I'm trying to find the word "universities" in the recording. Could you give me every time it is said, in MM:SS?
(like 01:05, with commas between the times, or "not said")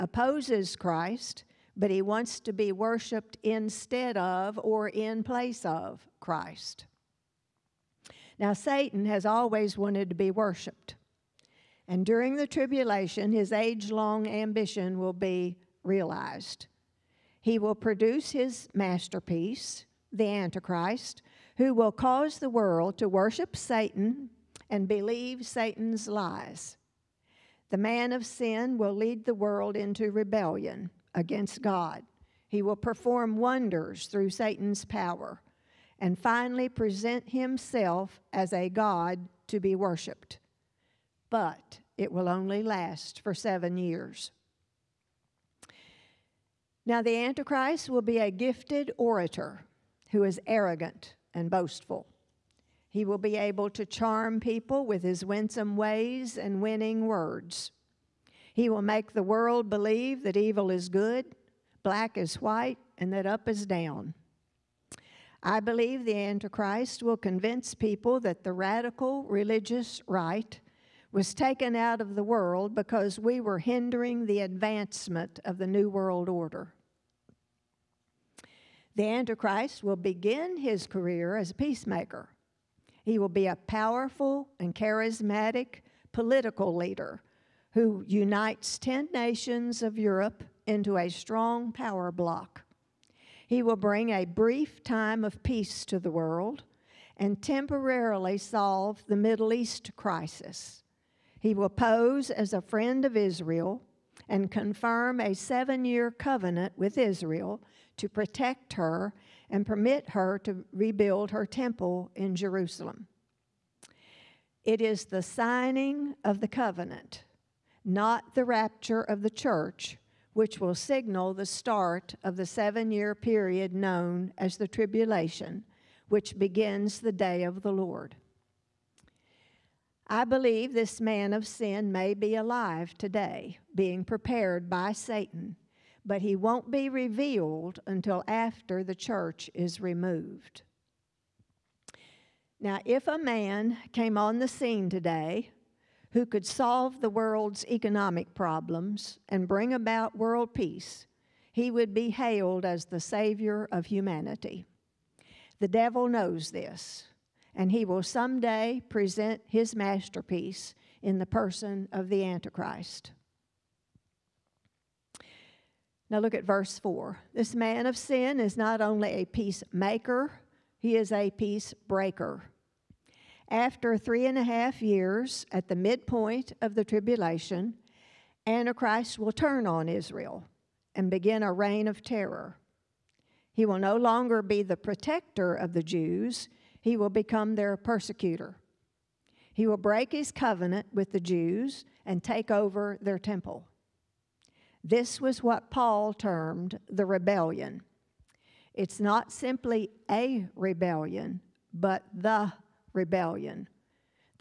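not said.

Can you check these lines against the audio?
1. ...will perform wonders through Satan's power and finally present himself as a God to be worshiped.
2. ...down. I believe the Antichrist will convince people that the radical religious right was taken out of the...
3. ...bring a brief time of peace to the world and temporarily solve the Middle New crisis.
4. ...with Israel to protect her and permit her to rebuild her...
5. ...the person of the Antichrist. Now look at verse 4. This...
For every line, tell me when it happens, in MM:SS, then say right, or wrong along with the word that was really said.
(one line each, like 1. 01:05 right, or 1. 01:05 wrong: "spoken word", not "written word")
1. 00:32 right
2. 01:03 right
3. 01:33 wrong: "East", not "New"
4. 01:46 right
5. 02:41 right.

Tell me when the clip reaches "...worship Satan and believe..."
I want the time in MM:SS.
00:23.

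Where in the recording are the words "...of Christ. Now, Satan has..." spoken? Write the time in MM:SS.
00:05.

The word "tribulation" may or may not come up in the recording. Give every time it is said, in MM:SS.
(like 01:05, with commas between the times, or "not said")
00:12, 02:04, 02:56.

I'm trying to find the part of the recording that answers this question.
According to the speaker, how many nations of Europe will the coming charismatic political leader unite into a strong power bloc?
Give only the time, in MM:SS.
01:28.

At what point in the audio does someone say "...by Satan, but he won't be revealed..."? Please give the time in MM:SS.
02:14.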